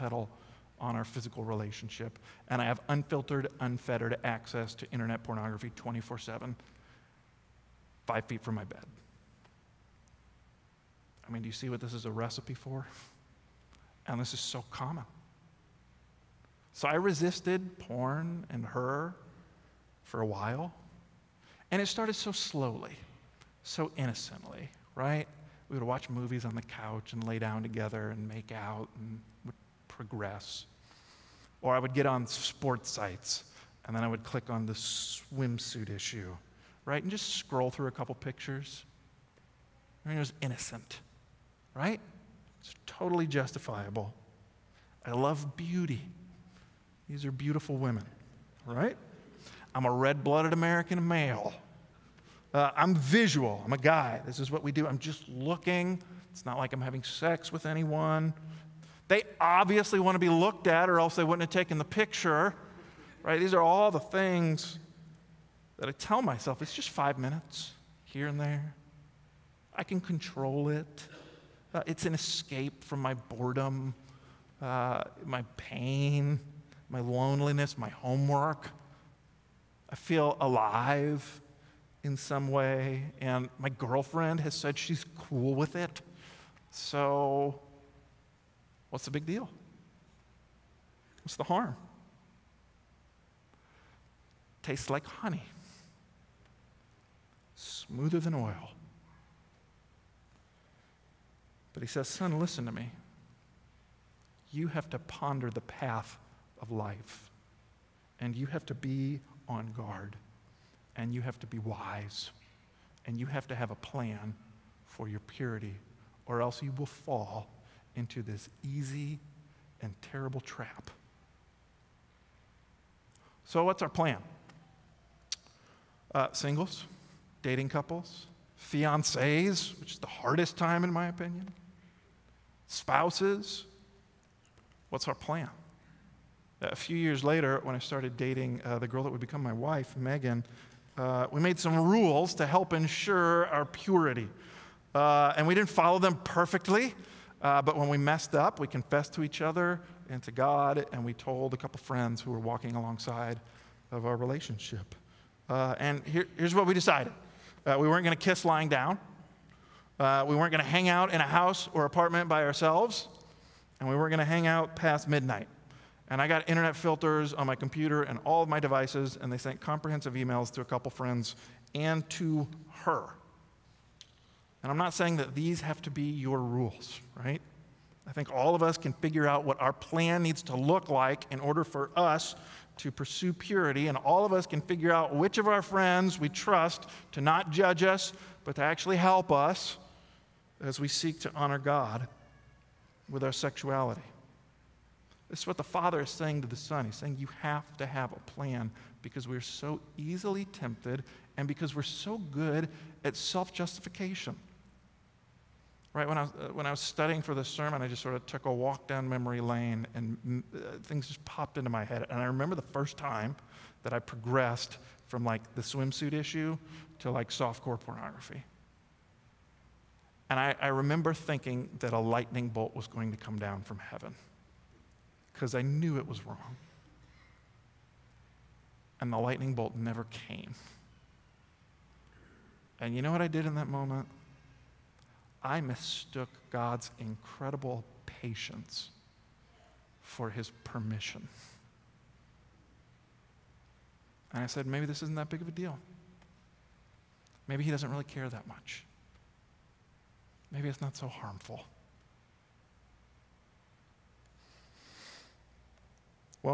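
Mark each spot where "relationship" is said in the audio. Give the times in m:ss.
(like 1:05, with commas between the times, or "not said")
0:01, 2:34.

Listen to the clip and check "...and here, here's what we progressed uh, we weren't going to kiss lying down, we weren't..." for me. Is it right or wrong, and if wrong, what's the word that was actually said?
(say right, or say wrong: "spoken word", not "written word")
wrong: "decided", not "progressed".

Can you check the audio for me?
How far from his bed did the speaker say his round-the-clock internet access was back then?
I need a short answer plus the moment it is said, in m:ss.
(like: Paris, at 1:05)
5 feet, at 0:08.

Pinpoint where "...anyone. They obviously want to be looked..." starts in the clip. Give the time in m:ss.
0:57.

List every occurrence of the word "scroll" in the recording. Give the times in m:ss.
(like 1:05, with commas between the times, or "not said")
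0:37.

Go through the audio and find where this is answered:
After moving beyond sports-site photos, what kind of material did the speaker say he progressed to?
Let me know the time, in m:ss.
3:37.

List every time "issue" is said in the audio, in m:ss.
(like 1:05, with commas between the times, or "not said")
0:35, 3:36.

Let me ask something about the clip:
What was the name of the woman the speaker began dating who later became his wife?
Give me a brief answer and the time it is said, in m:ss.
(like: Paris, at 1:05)
Megan, at 2:19.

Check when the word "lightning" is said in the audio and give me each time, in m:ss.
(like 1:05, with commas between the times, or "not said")
3:41, 3:49.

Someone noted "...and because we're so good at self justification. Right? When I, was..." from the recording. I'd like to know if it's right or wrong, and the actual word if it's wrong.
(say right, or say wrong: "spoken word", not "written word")
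right.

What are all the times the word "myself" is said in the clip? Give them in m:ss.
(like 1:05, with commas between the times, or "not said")
1:06.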